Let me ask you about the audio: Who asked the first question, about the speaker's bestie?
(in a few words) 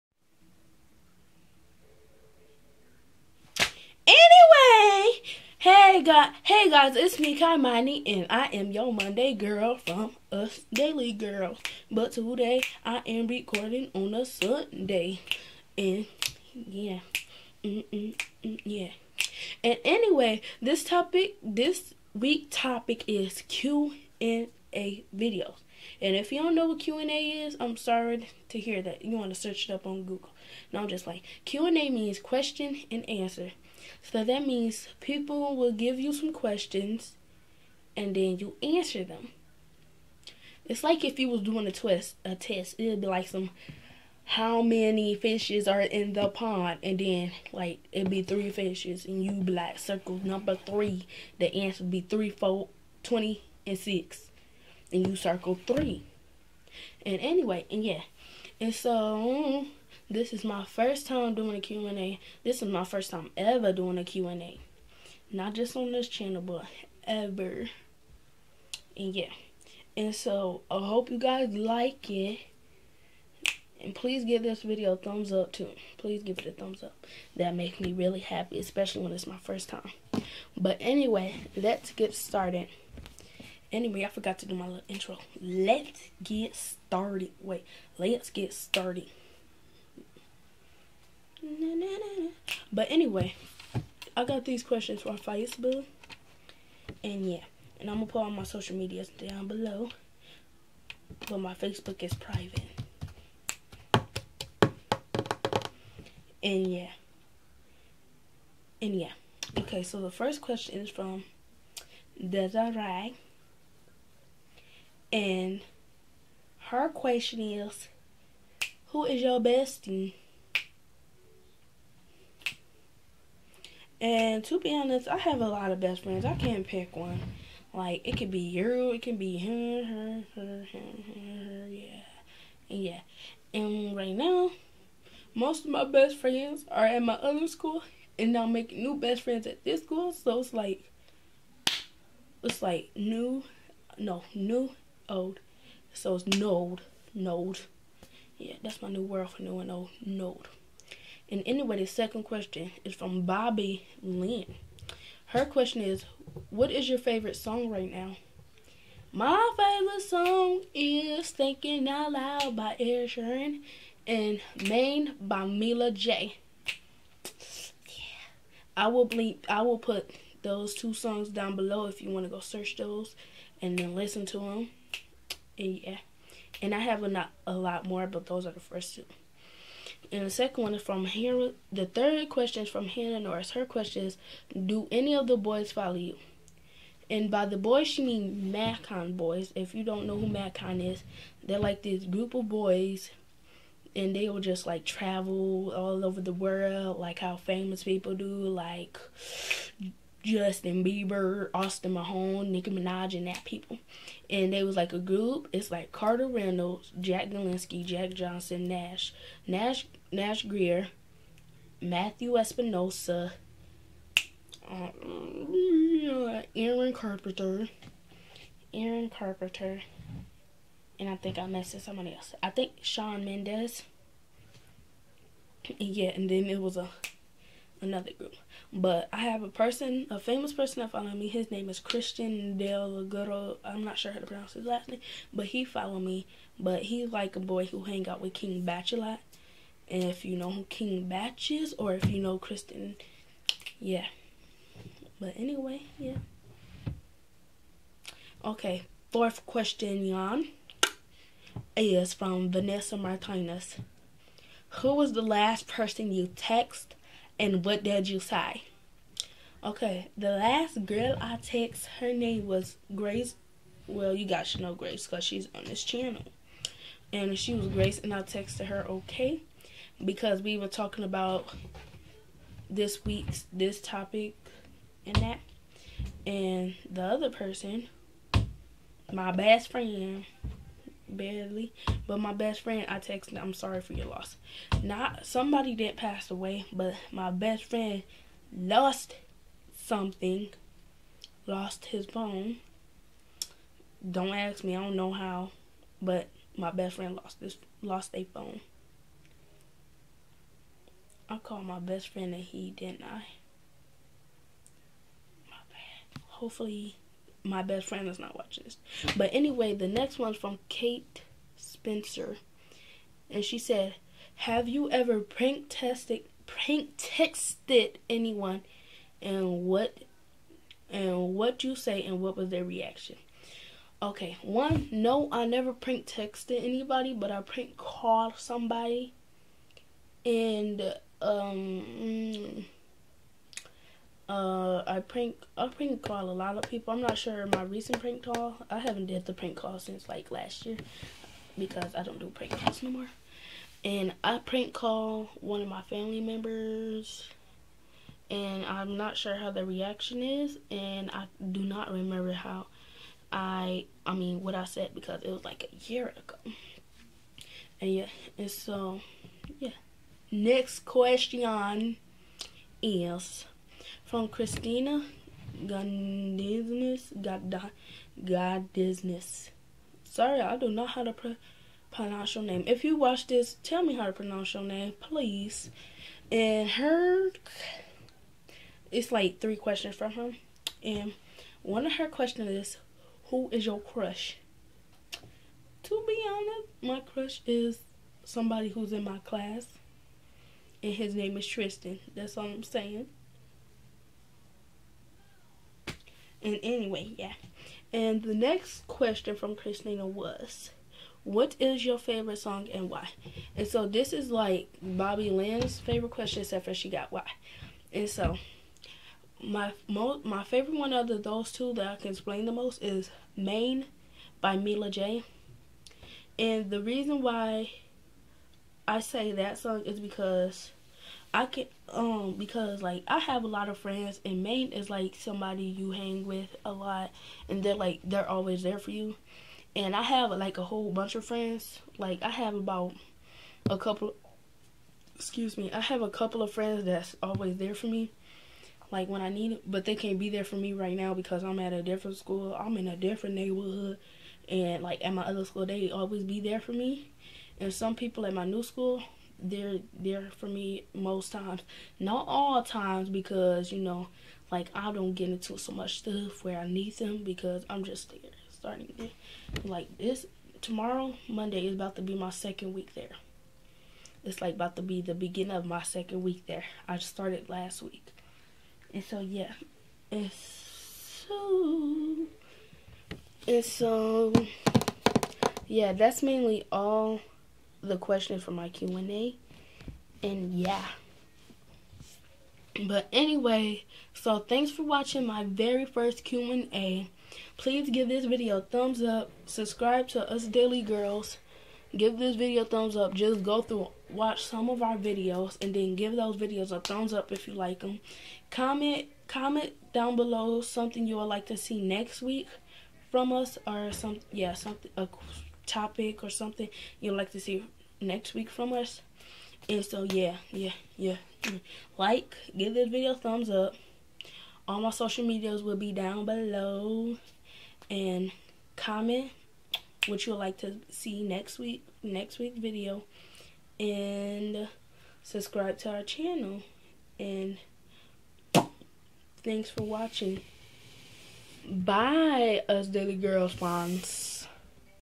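Desiree.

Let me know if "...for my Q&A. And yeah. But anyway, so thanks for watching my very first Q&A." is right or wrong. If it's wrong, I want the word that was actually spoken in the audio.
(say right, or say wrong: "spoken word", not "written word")
right.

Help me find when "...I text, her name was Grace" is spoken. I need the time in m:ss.
4:21.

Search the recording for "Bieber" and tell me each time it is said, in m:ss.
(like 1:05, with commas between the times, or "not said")
3:20.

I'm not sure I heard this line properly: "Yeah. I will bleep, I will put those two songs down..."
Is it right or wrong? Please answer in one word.
right.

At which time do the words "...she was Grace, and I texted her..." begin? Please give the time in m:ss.
4:27.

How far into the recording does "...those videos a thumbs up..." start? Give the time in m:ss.
8:16.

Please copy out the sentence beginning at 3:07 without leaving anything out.
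And by the boys, she means Magcon boys.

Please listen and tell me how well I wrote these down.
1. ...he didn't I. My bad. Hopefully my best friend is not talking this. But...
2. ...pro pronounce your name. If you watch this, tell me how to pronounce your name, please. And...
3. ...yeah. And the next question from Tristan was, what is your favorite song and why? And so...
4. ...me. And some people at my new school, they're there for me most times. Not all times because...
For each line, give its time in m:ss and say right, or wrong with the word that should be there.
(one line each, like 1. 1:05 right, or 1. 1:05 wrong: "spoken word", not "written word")
1. 5:02 wrong: "watching", not "talking"
2. 6:11 right
3. 6:37 wrong: "Christina", not "Tristan"
4. 7:26 right.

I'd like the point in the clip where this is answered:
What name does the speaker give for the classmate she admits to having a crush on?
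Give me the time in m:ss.
6:31.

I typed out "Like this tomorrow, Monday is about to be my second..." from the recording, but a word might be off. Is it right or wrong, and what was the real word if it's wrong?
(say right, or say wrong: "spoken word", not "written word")
right.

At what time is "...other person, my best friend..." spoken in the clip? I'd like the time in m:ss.
4:37.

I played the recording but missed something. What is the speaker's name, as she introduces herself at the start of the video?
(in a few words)
Kymani.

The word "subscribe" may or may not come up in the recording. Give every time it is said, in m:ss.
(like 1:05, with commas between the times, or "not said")
8:09, 8:45.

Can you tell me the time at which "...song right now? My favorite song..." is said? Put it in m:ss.
2:37.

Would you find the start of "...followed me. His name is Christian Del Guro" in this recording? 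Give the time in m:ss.
3:50.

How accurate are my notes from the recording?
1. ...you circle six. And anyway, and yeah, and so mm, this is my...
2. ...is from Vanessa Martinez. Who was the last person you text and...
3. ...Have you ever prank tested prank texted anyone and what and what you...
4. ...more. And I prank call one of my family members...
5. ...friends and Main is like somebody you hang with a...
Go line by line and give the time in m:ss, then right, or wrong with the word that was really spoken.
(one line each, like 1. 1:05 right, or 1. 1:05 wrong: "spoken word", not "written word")
1. 0:55 wrong: "three", not "six"
2. 4:11 right
3. 5:14 right
4. 5:42 right
5. 7:03 right.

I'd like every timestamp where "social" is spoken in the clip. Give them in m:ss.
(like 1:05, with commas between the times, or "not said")
1:38, 8:34.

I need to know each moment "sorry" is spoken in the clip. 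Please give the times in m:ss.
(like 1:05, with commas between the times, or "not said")
0:27, 4:43, 6:10.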